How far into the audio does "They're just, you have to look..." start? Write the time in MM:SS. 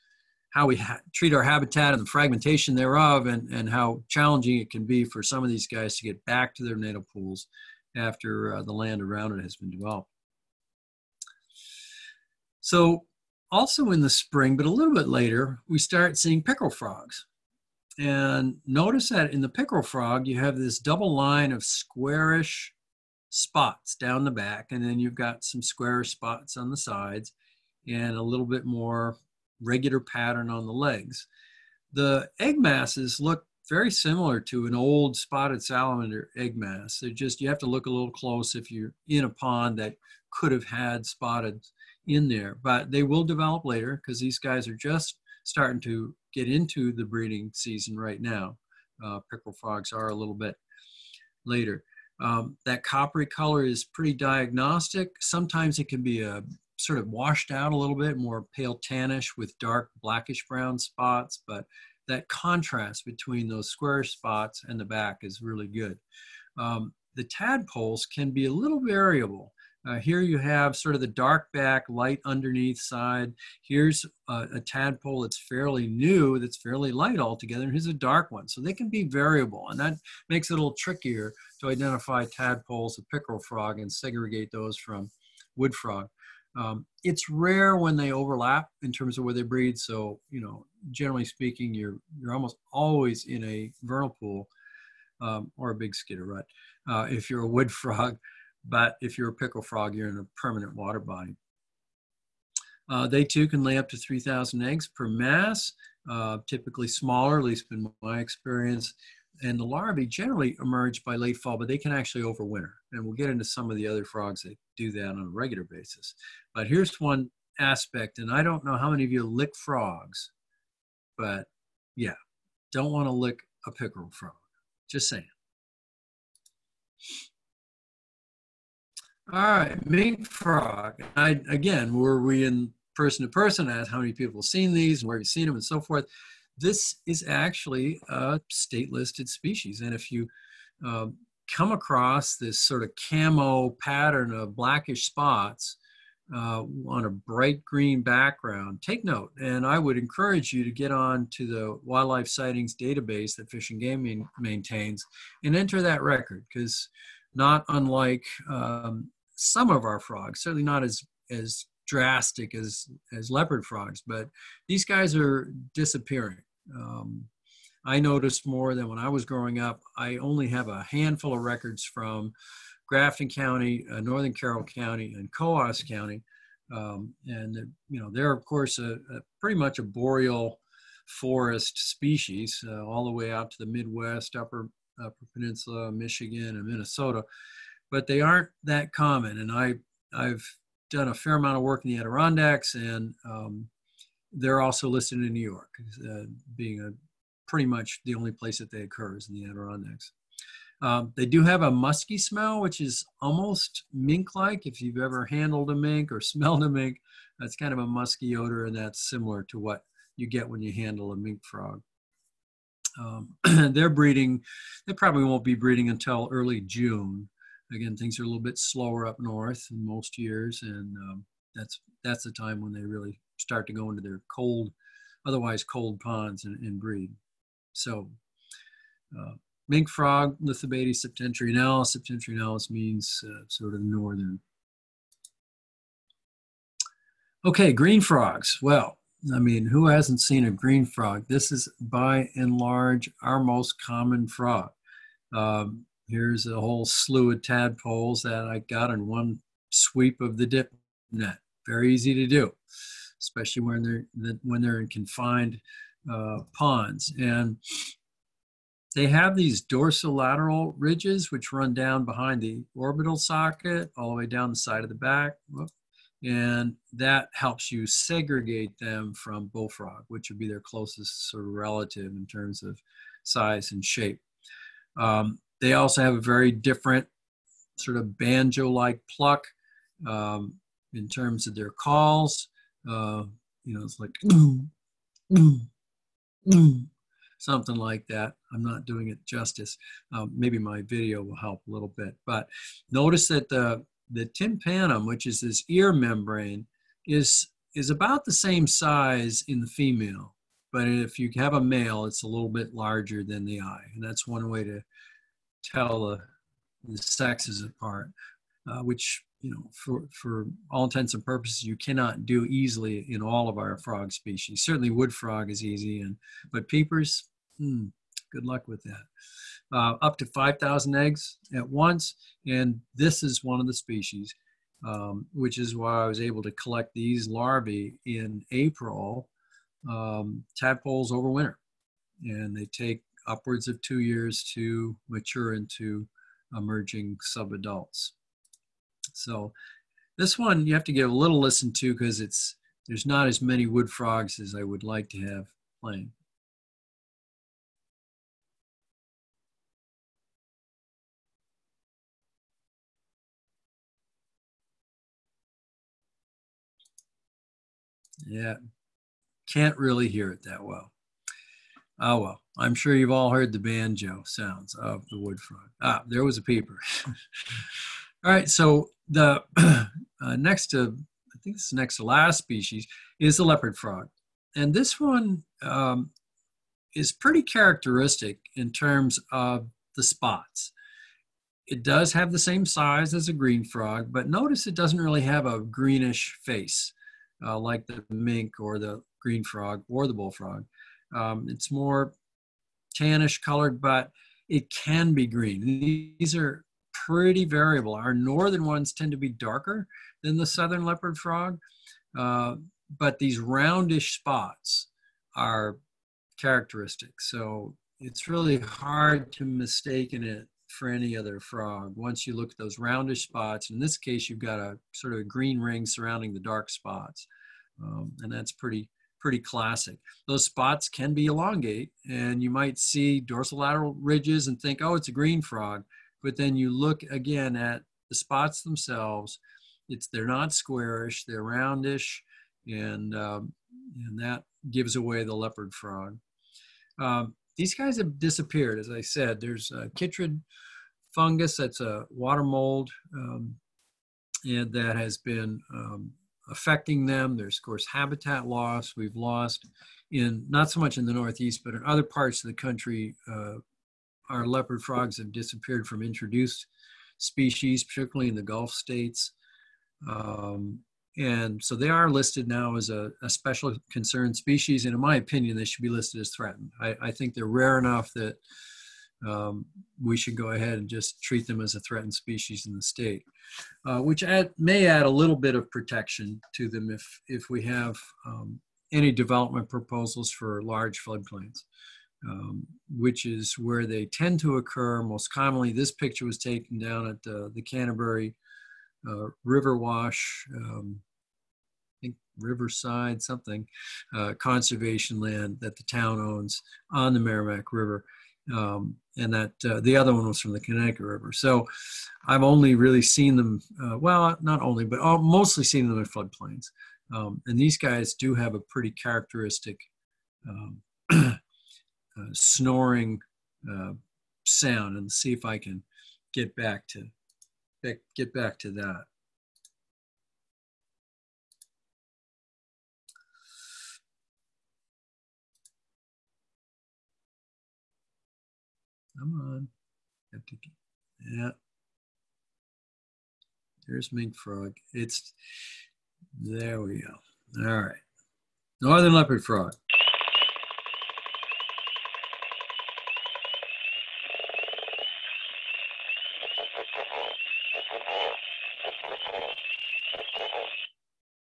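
00:36.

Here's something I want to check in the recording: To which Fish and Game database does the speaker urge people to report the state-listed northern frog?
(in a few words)
Wildlife sightings database.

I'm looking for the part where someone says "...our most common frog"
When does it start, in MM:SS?
04:03.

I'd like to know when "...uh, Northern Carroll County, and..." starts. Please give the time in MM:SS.
02:53.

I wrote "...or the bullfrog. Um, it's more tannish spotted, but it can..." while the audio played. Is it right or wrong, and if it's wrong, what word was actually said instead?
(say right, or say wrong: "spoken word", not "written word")
wrong: "colored", not "spotted".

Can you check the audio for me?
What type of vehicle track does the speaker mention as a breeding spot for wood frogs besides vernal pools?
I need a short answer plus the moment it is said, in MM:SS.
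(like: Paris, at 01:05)
Skidder rut, at 01:35.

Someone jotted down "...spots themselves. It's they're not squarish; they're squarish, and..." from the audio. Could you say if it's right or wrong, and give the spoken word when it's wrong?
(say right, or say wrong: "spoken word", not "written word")
wrong: "roundish", not "squarish".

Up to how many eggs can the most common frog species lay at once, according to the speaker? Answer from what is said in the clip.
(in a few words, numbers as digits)
5,000.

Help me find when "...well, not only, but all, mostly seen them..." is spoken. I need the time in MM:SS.
08:23.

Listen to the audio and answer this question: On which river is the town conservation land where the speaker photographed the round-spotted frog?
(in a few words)
Merrimack River.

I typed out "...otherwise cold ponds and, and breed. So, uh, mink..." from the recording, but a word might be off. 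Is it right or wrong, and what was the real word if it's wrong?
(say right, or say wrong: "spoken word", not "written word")
right.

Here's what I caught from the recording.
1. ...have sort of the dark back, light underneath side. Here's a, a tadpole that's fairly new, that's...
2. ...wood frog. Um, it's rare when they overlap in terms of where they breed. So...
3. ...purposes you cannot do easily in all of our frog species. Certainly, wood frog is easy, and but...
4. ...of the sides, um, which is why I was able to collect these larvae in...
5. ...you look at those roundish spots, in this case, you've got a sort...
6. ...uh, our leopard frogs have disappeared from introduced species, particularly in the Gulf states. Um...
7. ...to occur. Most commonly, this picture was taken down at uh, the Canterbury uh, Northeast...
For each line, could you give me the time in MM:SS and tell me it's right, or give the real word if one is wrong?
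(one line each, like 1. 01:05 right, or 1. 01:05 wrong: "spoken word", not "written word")
1. 01:10 right
2. 01:25 right
3. 05:11 right
4. 05:23 wrong: "species", not "sides"
5. 06:52 right
6. 07:33 right
7. 08:04 wrong: "River", not "Northeast".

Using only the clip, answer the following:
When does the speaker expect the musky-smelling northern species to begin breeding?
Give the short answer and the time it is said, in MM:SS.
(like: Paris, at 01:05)
Early June, at 03:36.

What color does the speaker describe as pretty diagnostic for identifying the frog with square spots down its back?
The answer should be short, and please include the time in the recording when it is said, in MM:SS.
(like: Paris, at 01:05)
Coppery, at 00:52.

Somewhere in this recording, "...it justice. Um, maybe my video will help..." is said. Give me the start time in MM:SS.
04:49.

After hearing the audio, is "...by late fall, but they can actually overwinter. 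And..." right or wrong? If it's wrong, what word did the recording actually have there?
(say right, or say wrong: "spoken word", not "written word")
right.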